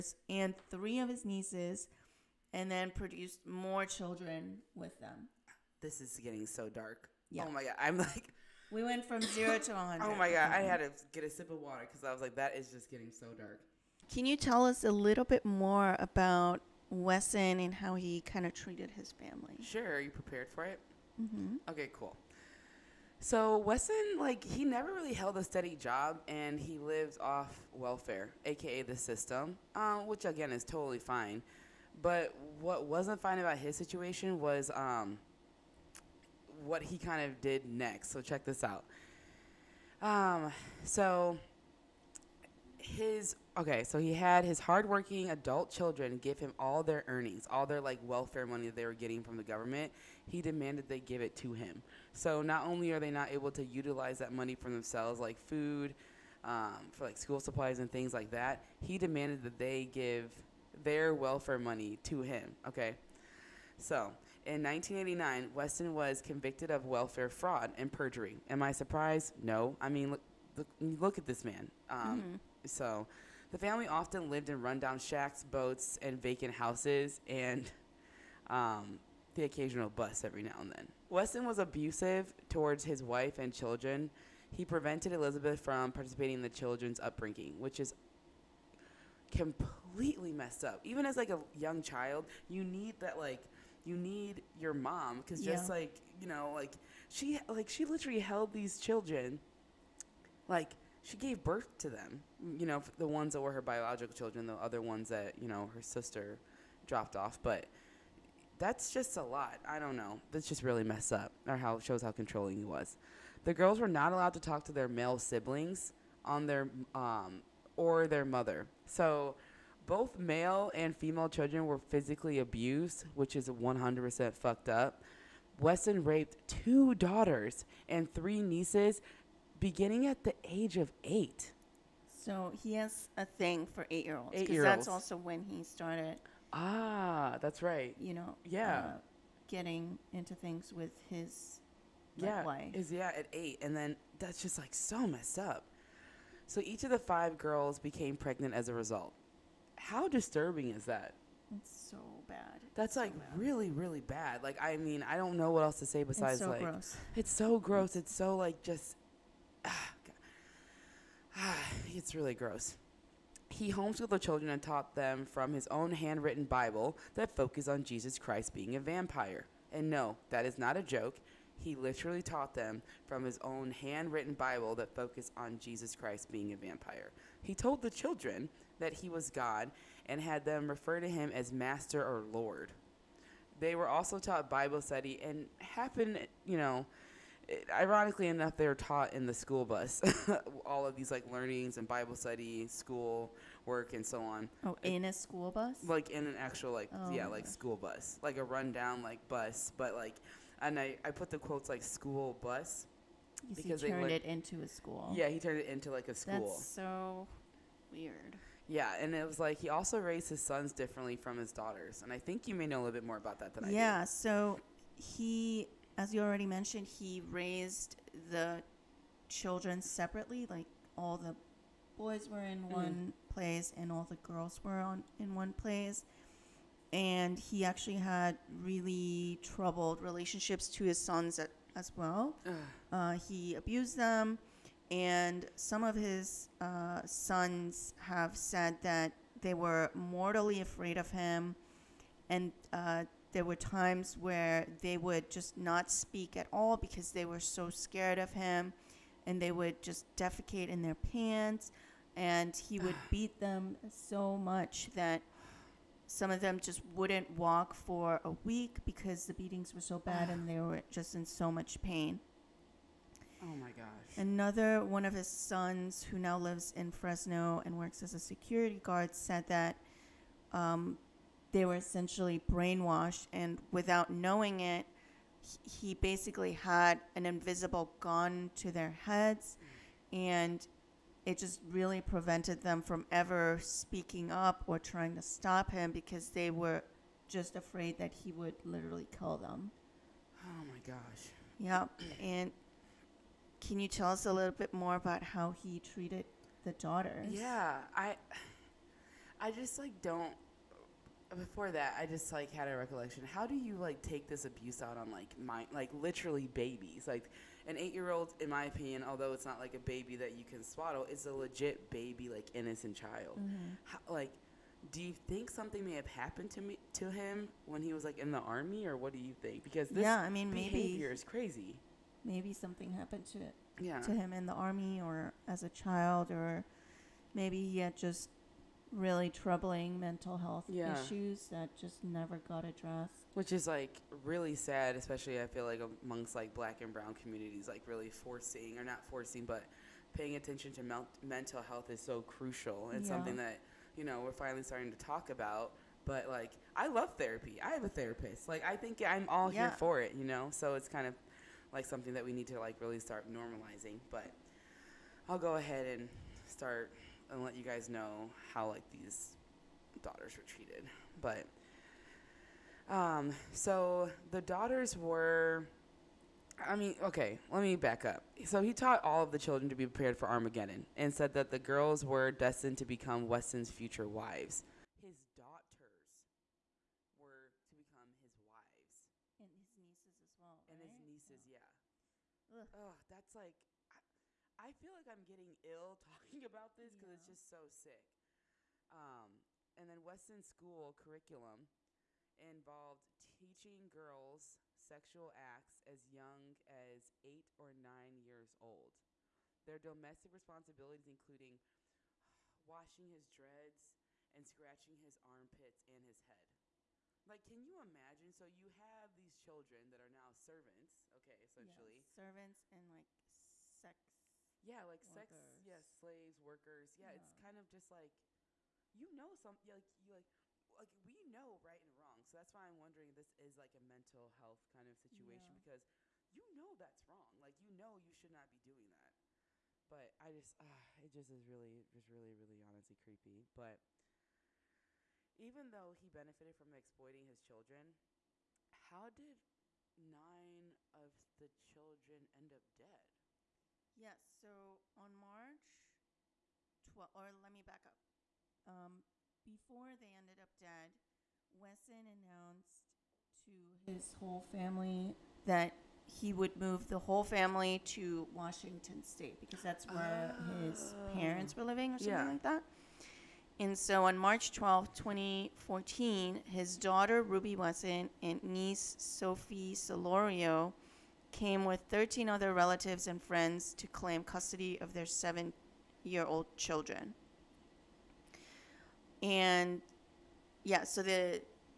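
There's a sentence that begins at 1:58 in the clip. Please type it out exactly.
So both male and female children were physically abused, which is 100% fucked up.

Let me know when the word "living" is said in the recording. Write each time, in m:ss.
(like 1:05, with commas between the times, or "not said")
7:41.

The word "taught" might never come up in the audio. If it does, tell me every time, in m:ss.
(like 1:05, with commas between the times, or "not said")
2:44, 2:52, 3:04, 3:08, 6:08.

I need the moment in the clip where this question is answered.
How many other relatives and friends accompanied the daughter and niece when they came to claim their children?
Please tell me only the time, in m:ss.
7:51.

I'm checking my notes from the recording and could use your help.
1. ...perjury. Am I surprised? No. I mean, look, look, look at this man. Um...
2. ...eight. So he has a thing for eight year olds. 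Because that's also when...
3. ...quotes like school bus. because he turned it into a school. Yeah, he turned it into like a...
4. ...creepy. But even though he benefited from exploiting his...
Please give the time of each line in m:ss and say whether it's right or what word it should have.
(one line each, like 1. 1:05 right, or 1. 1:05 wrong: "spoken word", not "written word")
1. 1:07 right
2. 2:11 right
3. 3:21 right
4. 7:12 right.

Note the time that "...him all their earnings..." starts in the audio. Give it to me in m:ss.
0:46.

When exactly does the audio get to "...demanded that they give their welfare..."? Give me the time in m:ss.
0:58.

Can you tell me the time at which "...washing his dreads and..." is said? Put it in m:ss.
6:42.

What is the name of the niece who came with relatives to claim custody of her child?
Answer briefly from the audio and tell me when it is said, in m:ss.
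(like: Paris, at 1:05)
Sophie Solorio, at 7:48.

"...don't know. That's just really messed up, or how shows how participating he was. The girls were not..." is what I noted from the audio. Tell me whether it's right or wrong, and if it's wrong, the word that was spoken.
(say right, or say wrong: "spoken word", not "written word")
wrong: "controlling", not "participating".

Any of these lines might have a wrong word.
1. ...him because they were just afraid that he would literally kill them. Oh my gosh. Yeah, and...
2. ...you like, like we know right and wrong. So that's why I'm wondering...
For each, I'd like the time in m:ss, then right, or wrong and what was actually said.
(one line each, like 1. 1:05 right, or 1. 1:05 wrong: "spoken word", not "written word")
1. 4:45 right
2. 7:00 right.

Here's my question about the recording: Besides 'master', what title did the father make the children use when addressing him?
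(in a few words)
Lord.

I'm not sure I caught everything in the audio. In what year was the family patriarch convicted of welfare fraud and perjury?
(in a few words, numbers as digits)
1989.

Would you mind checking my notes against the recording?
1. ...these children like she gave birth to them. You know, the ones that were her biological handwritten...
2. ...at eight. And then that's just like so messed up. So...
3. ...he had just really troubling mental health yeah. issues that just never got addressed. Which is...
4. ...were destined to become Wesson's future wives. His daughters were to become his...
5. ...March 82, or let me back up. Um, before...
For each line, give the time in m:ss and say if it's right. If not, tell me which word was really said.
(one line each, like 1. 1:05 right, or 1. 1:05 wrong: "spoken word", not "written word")
1. 1:38 wrong: "children", not "handwritten"
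2. 2:23 right
3. 5:27 right
4. 6:12 right
5. 7:25 wrong: "12", not "82".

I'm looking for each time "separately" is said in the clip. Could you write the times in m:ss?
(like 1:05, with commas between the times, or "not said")
3:39.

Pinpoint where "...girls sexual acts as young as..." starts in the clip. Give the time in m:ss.
6:33.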